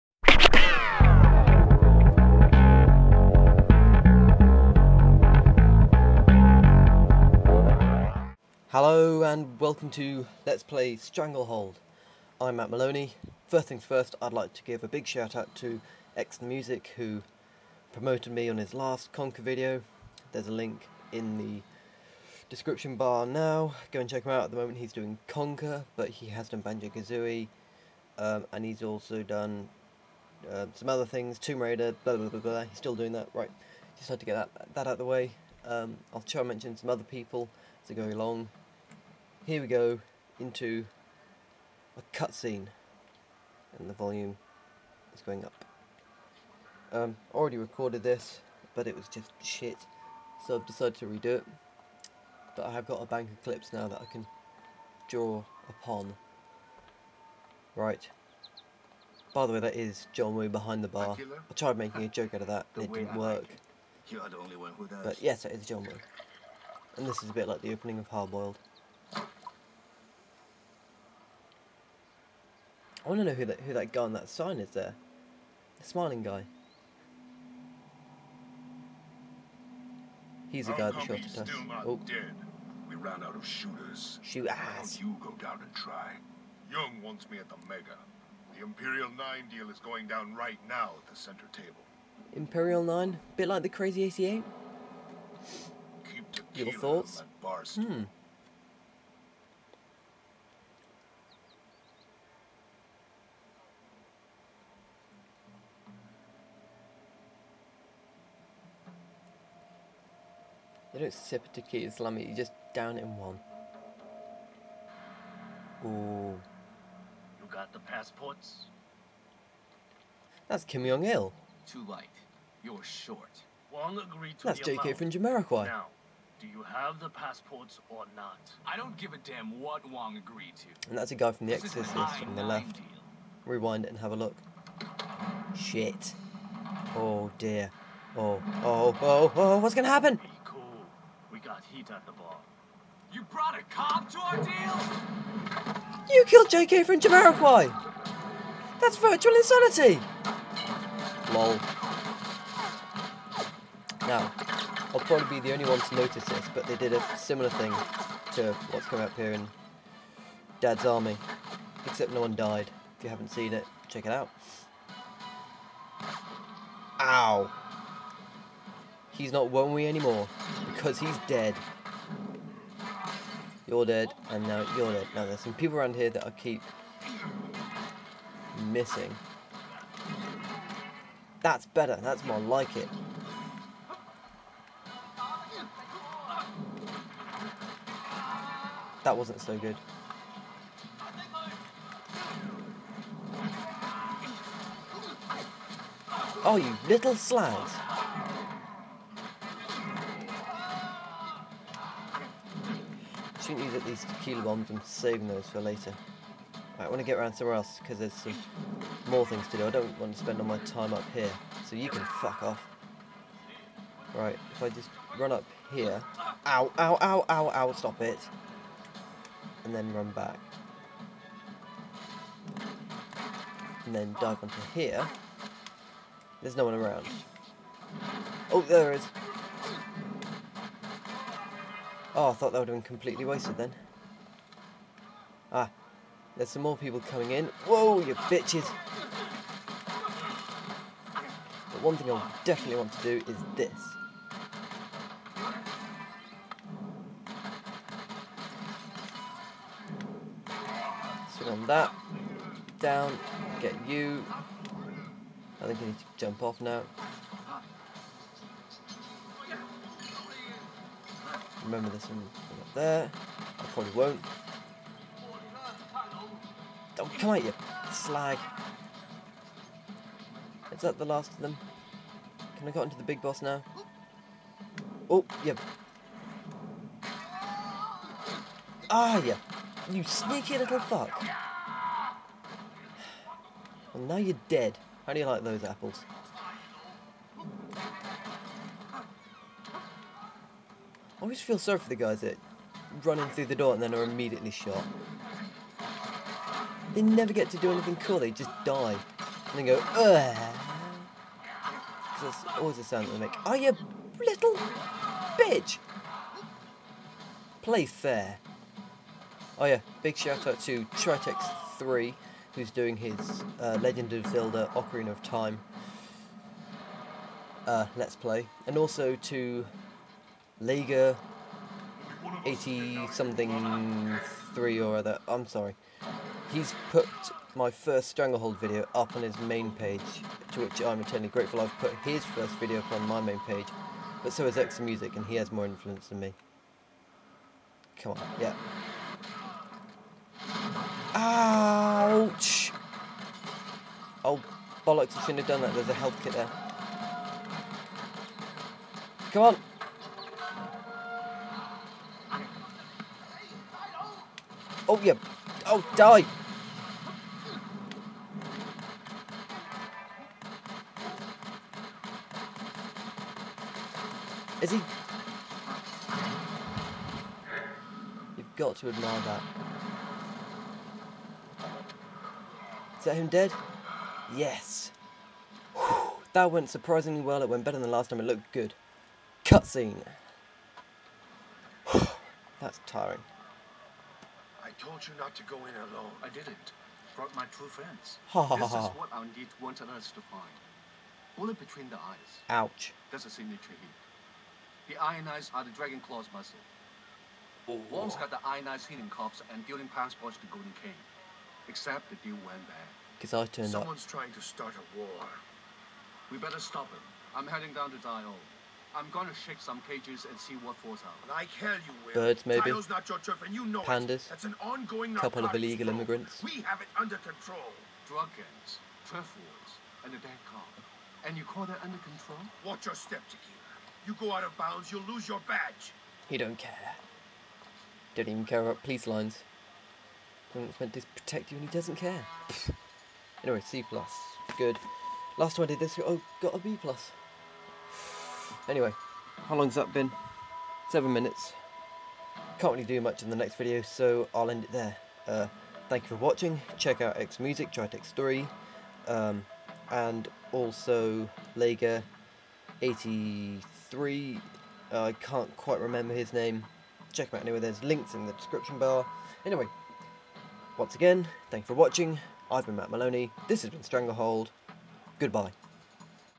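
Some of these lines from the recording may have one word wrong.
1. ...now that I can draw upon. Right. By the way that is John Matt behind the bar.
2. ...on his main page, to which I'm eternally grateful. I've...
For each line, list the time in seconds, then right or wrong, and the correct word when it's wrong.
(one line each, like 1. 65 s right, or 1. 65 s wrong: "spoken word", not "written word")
1. 53 s wrong: "Woo", not "Matt"
2. 329 s right.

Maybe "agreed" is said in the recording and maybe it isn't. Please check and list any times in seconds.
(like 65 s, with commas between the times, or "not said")
123 s, 130 s.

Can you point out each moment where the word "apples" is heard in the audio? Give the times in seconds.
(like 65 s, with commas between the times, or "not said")
285 s.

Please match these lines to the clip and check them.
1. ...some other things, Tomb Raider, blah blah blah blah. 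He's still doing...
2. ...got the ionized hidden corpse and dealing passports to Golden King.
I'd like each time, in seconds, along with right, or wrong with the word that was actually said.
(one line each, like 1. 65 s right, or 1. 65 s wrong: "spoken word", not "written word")
1. 30 s right
2. 398 s right.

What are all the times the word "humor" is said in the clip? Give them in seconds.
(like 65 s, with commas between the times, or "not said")
not said.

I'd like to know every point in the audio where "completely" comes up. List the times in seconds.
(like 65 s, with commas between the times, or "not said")
232 s.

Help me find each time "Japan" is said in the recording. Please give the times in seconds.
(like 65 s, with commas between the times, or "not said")
not said.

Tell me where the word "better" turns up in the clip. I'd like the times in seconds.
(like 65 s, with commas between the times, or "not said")
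181 s, 377 s, 406 s.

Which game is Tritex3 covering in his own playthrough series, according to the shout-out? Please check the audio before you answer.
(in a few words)
Ocarina of Time.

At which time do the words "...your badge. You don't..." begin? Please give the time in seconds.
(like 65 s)
425 s.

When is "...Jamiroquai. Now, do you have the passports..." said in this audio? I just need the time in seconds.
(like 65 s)
125 s.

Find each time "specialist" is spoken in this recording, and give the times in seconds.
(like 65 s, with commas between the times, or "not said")
not said.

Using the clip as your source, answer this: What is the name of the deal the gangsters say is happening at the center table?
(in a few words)
Imperial 9.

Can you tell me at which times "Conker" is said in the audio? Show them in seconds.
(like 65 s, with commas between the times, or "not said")
19 s, 25 s.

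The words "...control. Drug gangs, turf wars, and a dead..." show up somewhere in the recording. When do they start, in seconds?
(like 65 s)
417 s.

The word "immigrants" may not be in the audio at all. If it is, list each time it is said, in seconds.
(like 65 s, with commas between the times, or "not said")
415 s.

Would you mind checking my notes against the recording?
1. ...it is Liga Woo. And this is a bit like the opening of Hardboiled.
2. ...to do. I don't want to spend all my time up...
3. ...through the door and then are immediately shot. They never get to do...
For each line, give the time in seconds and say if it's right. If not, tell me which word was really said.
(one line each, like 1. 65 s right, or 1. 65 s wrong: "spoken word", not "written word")
1. 65 s wrong: "John", not "Liga"
2. 209 s right
3. 293 s right.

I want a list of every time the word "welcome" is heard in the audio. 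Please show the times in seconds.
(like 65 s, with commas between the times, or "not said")
9 s.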